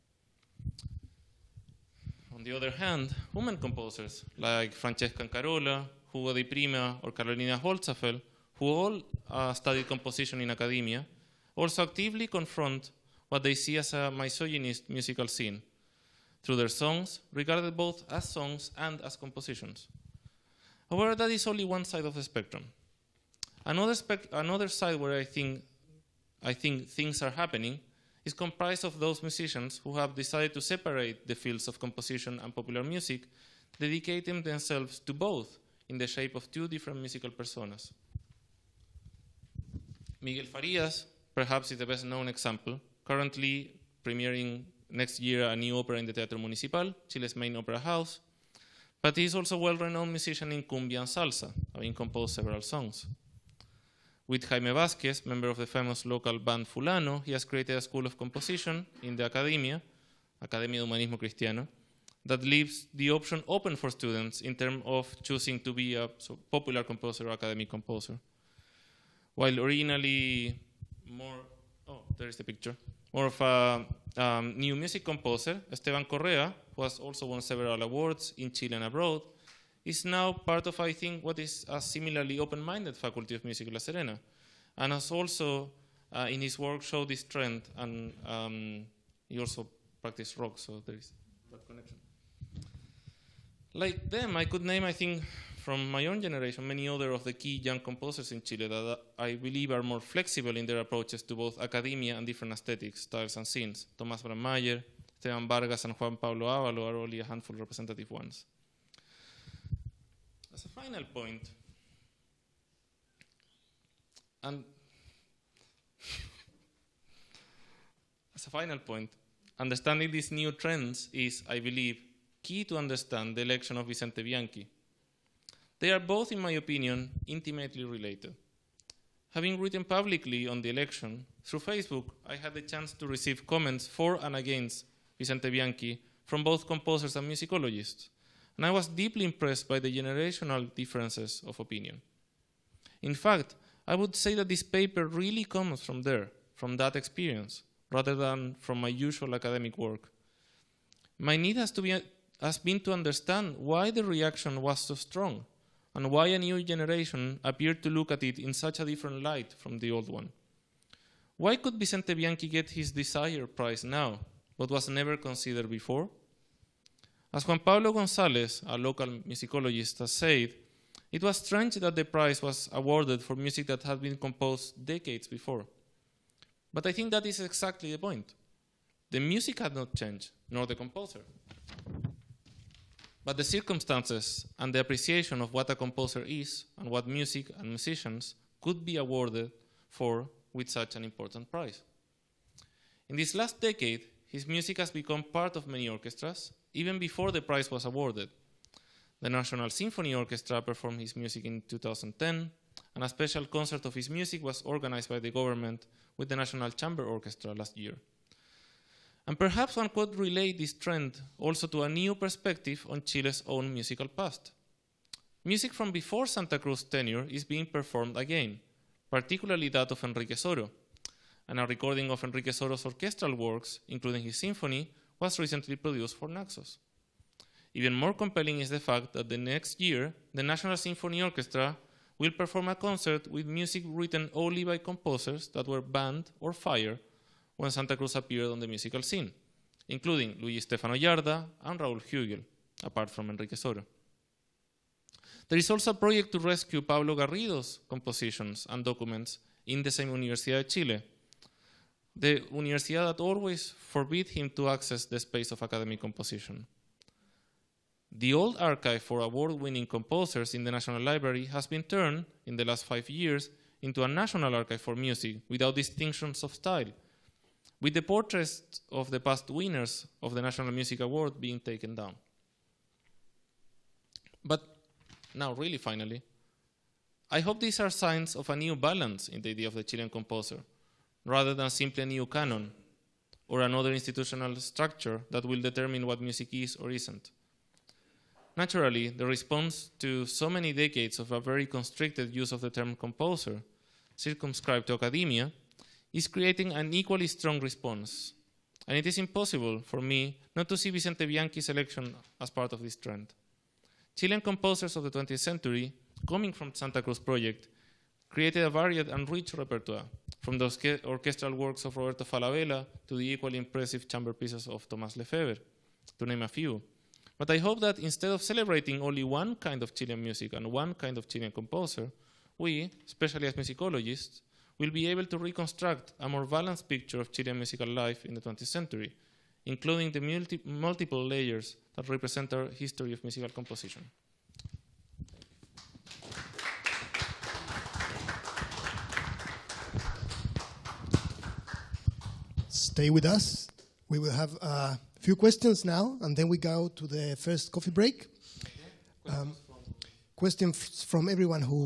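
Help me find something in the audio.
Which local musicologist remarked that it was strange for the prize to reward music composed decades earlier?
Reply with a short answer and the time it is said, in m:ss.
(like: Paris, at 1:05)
Juan Pablo Gonzalez, at 2:47.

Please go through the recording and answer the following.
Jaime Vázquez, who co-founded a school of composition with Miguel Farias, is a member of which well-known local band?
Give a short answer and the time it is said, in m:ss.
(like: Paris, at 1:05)
Fulano, at 0:56.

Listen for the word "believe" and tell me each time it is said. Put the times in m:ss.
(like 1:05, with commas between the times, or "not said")
1:39, 2:01.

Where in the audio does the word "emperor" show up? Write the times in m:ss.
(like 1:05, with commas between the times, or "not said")
not said.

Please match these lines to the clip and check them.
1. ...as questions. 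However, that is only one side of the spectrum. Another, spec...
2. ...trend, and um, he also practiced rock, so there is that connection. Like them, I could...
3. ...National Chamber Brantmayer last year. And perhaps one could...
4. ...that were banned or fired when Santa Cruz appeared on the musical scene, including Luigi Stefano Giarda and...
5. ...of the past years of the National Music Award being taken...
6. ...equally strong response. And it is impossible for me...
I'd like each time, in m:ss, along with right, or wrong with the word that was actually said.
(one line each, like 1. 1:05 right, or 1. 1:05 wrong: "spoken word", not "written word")
1. 0:18 wrong: "compositions", not "questions"
2. 1:27 right
3. 3:26 wrong: "Orchestra", not "Brantmayer"
4. 3:55 right
5. 4:28 wrong: "winners", not "years"
6. 4:56 right.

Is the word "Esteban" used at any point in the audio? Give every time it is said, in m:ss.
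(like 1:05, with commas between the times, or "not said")
1:15, 1:45.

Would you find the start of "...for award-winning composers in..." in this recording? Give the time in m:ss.
4:19.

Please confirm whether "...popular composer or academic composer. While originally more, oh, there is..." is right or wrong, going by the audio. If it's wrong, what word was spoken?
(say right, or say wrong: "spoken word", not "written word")
right.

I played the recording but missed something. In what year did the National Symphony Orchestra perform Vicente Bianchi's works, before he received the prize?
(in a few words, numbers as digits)
2010.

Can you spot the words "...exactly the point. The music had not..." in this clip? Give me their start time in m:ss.
2:57.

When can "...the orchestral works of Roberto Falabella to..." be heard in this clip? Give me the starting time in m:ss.
5:10.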